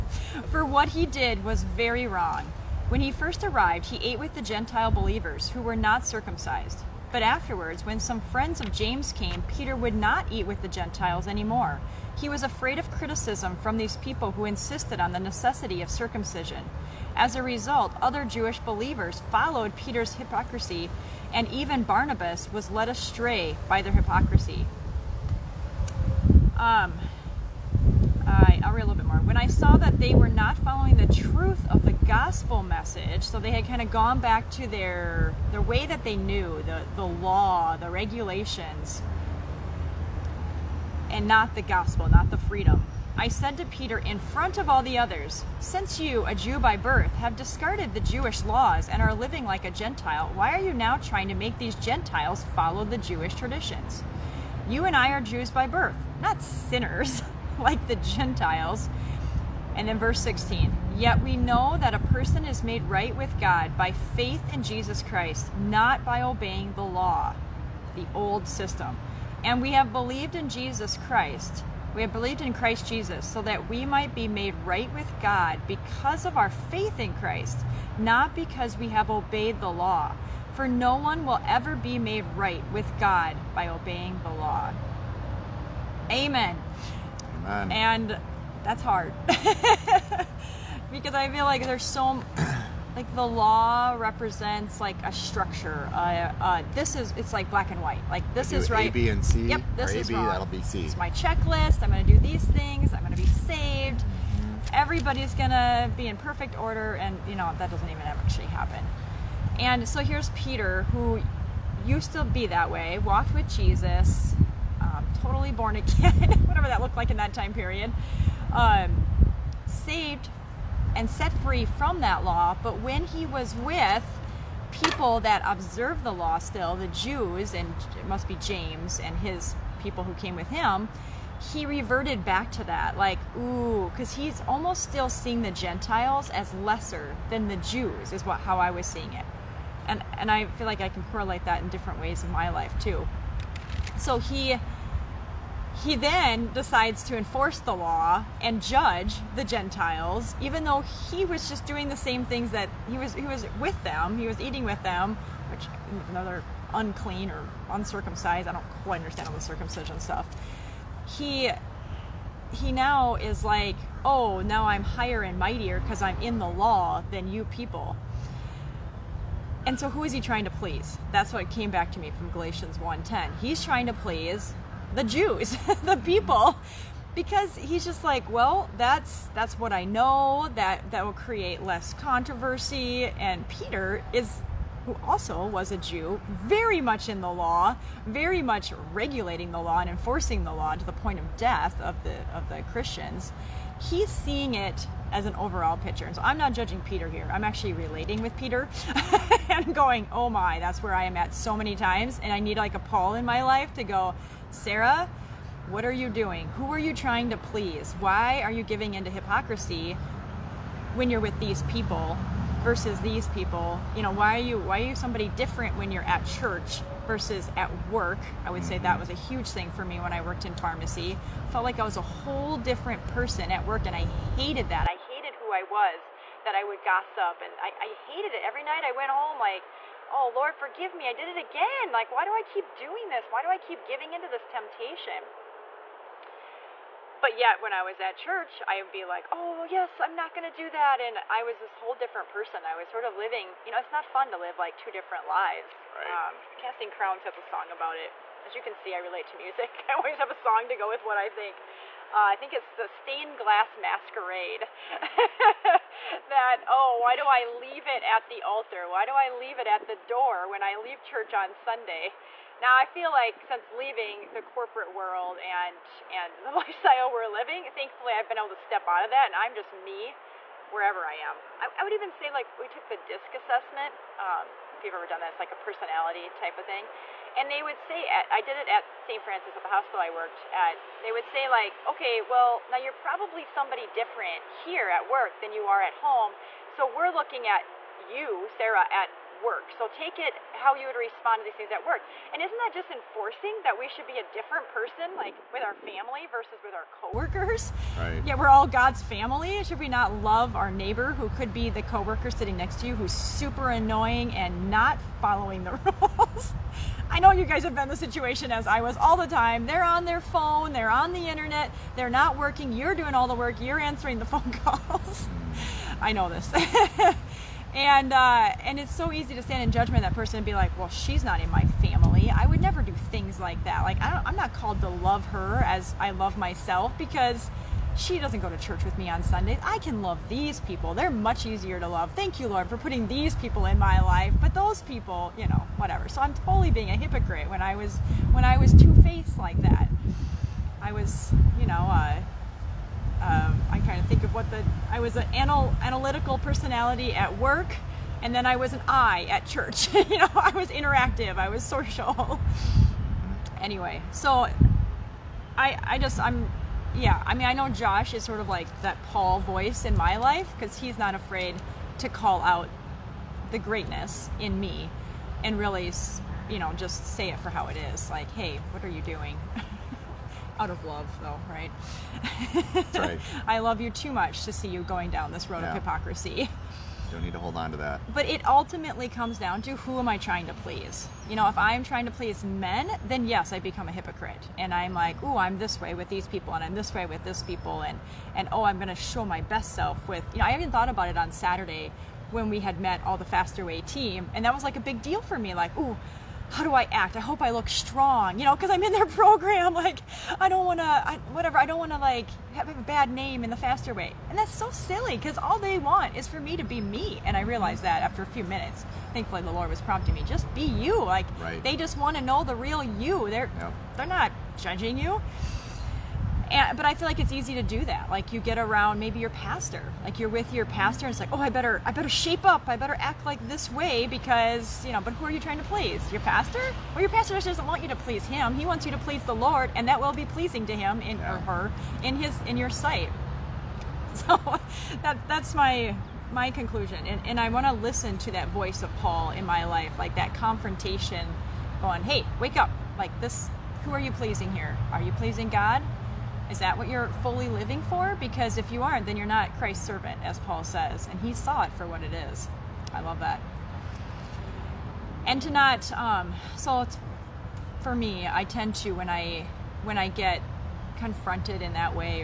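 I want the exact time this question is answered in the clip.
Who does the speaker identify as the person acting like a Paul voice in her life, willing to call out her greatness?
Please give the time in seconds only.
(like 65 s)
357 s.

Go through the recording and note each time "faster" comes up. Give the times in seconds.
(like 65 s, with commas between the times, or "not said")
393 s, 403 s.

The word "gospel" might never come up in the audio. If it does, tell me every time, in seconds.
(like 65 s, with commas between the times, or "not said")
31 s, 41 s.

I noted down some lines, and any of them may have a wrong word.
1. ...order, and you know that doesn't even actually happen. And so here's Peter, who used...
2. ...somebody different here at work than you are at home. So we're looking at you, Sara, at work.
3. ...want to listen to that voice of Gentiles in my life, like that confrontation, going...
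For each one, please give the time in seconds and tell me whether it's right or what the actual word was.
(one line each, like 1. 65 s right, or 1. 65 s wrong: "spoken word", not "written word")
1. 106 s right
2. 283 s right
3. 437 s wrong: "Paul", not "Gentiles".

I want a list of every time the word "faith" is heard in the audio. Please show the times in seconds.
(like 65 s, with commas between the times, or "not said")
64 s, 76 s.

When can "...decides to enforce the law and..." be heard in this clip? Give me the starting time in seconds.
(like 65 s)
146 s.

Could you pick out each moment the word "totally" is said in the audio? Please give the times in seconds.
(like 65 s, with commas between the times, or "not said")
115 s, 336 s.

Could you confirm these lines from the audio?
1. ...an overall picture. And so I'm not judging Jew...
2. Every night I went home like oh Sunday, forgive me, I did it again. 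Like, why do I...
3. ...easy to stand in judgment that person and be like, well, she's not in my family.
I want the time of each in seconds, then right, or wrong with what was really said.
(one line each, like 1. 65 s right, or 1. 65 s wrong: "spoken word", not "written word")
1. 195 s wrong: "Peter", not "Jew"
2. 228 s wrong: "Lord", not "Sunday"
3. 319 s right.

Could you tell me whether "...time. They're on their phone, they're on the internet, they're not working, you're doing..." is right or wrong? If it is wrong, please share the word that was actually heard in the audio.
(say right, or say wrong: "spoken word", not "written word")
right.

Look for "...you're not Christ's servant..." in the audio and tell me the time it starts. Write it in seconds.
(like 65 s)
449 s.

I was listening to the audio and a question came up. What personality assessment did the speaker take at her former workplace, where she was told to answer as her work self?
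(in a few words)
DISC assessment.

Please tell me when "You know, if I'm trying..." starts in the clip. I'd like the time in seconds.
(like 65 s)
381 s.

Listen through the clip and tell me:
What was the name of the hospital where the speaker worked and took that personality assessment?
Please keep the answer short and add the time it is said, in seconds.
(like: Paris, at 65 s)
St. Francis, at 279 s.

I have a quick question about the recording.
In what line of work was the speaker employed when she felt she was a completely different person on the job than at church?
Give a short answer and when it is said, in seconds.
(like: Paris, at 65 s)
Pharmacy, at 220 s.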